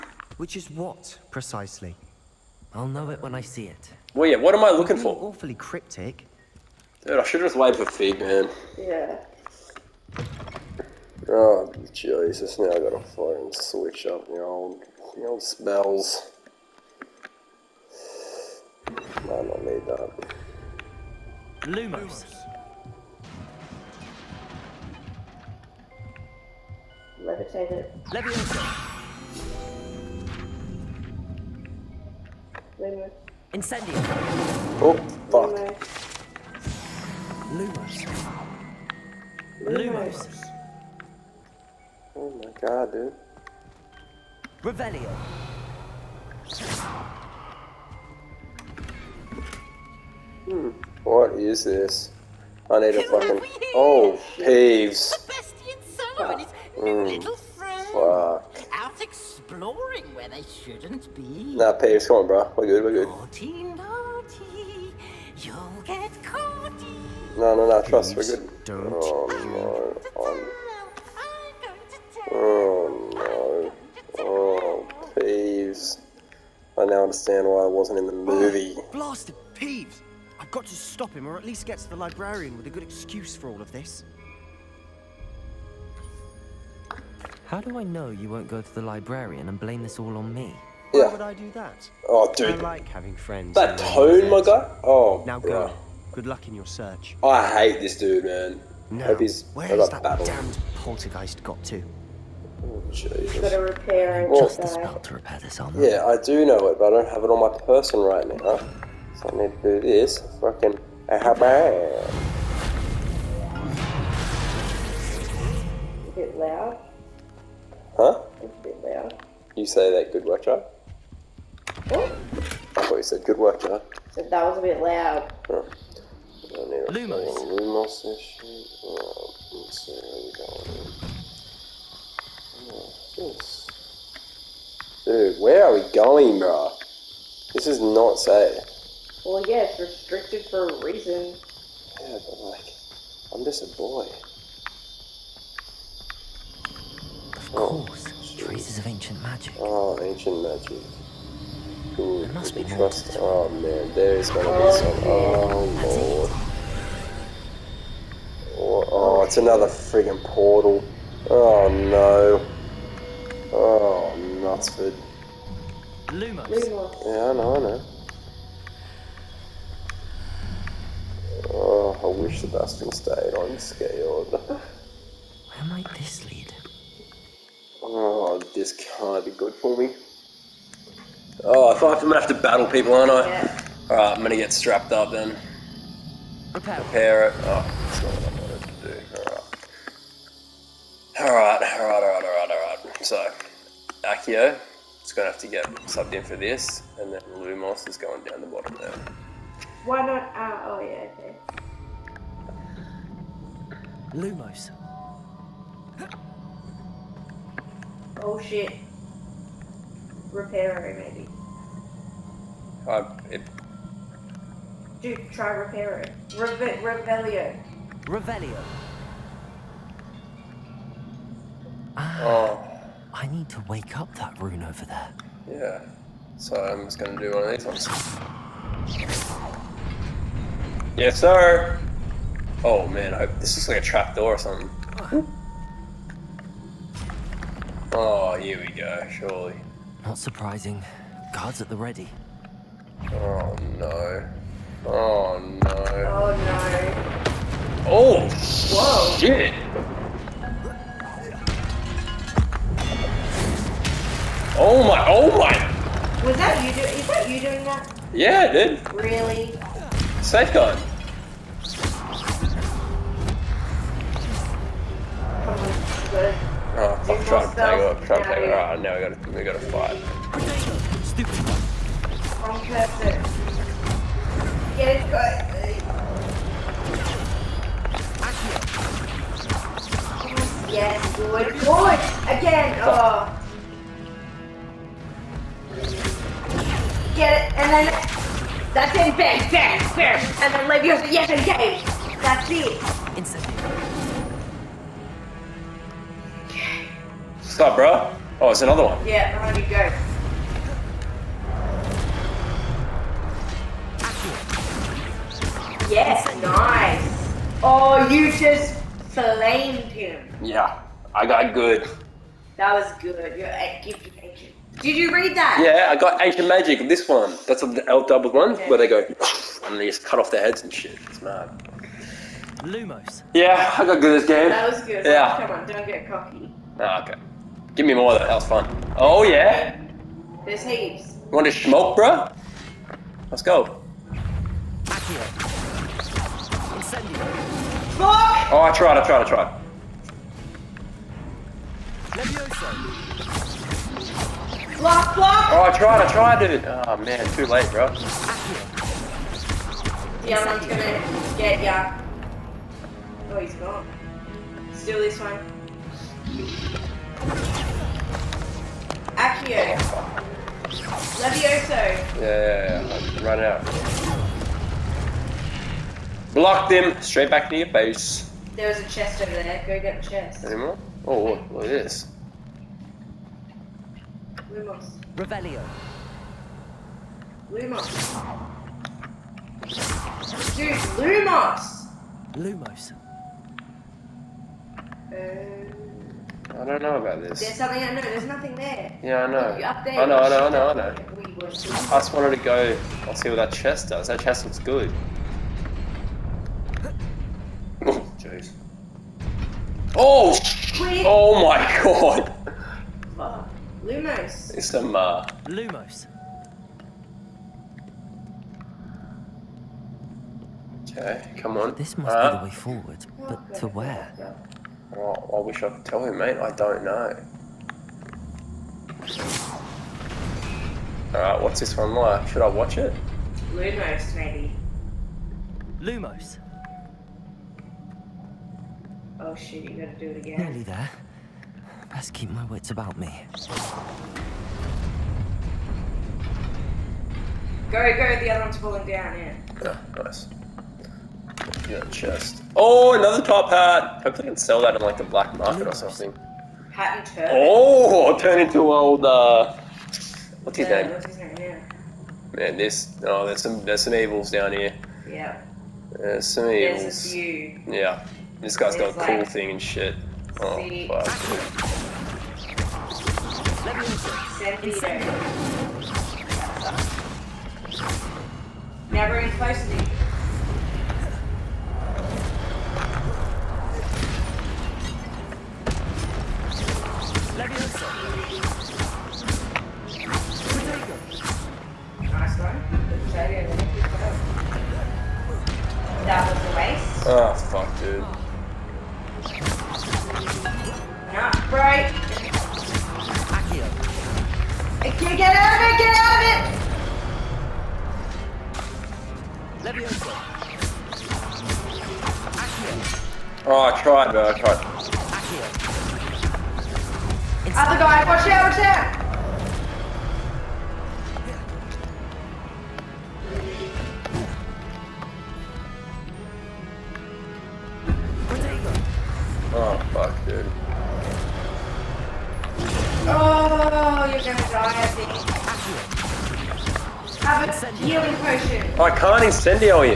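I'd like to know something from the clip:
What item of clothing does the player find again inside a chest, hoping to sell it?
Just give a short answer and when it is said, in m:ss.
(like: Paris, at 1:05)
Top hat, at 7:23.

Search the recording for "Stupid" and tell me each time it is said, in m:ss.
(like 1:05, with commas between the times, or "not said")
4:31.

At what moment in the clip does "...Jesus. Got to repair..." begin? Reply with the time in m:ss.
1:42.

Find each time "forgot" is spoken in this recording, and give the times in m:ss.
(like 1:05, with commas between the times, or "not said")
not said.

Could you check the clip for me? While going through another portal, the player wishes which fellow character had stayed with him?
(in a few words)
Sebastian.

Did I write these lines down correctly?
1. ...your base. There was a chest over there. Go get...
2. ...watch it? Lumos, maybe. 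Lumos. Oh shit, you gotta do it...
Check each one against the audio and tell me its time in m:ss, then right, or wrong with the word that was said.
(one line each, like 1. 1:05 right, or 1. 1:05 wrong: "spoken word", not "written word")
1. 6:07 right
2. 7:02 right.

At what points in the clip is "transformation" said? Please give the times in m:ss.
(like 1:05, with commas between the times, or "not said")
not said.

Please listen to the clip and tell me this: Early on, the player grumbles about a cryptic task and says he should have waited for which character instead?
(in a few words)
Fig.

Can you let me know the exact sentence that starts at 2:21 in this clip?
Yeah, but like, I'm just a boy.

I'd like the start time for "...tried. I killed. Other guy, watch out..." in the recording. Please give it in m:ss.
8:24.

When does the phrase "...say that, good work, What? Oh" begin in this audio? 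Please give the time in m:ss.
1:59.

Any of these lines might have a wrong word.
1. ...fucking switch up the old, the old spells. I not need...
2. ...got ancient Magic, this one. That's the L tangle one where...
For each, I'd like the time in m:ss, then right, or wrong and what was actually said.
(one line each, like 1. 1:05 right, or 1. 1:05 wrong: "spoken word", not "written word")
1. 0:13 right
2. 5:15 wrong: "double", not "tangle".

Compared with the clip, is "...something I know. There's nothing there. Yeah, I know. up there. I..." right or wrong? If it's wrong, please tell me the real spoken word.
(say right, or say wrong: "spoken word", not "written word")
right.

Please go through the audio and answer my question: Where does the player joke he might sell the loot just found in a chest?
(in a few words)
The black market.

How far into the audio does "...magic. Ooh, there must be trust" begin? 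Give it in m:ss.
2:30.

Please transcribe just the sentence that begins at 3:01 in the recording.
Oh, I feel I'm gonna have to battle people, aren't I?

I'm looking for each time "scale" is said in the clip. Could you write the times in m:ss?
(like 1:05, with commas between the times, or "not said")
2:53.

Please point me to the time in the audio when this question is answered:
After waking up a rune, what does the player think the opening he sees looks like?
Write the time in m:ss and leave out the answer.
3:53.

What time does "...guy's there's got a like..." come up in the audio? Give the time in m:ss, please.
7:38.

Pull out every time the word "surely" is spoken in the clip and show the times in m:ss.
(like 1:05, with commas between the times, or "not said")
3:59.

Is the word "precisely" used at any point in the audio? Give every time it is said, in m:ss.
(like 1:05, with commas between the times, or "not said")
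0:01.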